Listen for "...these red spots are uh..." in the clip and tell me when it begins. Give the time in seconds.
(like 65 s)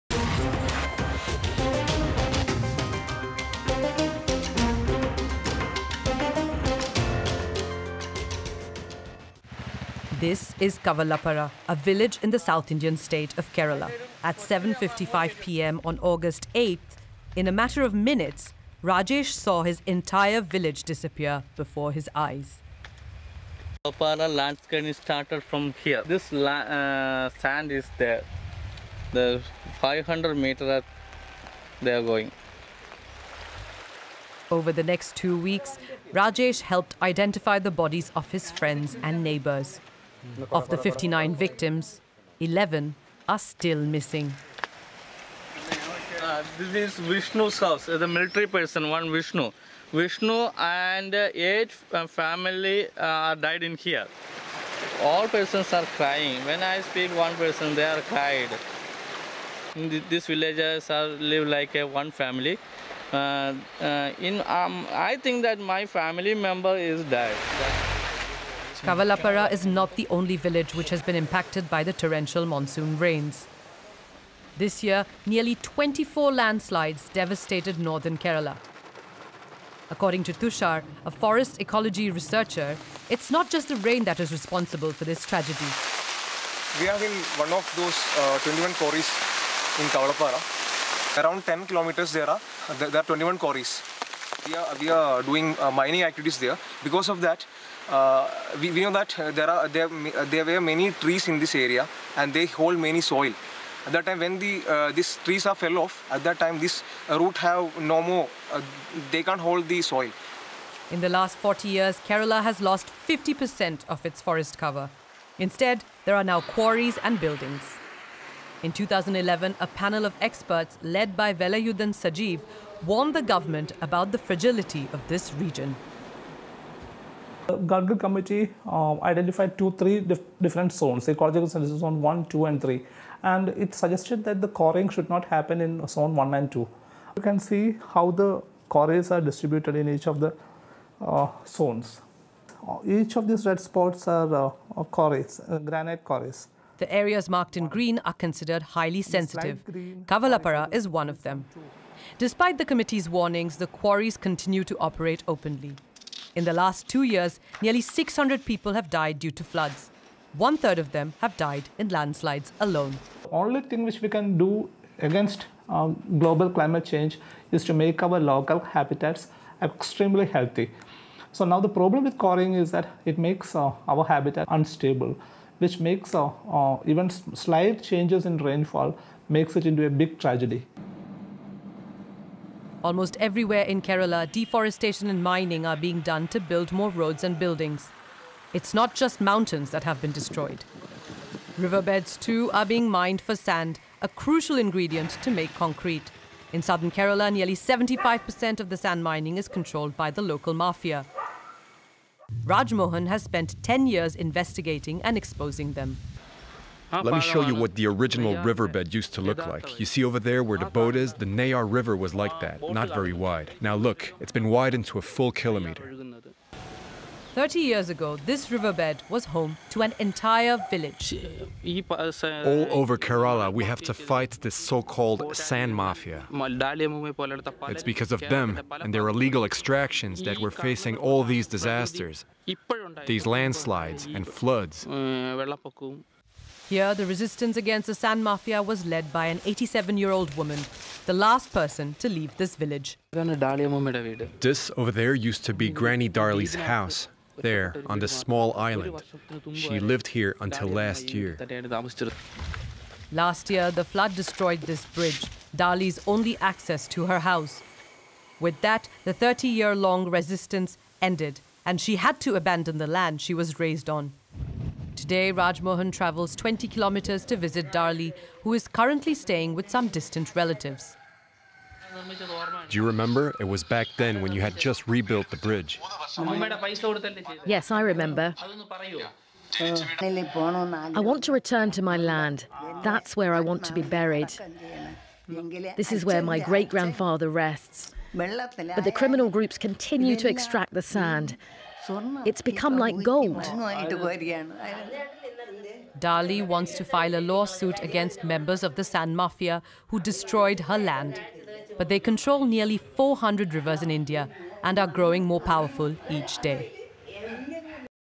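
143 s.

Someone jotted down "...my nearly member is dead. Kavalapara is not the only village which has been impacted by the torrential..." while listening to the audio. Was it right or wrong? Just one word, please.
wrong.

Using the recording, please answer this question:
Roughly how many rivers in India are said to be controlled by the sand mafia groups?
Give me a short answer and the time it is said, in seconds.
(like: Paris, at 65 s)
400, at 302 s.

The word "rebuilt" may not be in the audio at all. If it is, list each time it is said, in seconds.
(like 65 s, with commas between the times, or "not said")
274 s.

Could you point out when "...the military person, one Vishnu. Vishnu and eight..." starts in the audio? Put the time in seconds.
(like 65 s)
47 s.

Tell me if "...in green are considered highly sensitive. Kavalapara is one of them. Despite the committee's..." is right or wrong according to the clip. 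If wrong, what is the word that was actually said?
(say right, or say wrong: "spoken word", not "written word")
right.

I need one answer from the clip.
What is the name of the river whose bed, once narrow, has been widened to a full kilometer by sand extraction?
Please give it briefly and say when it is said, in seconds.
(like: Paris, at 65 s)
Neyyar River, at 211 s.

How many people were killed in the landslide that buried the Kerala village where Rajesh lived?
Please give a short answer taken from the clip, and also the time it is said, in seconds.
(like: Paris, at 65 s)
59, at 40 s.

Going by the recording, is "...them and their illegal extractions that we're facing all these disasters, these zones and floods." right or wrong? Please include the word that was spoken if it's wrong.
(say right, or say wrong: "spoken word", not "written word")
wrong: "landslides", not "zones".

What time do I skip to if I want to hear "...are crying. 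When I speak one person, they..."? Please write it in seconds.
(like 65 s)
55 s.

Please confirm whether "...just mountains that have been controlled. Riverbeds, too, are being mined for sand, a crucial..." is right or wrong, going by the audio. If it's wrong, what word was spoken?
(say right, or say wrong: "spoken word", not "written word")
wrong: "destroyed", not "controlled".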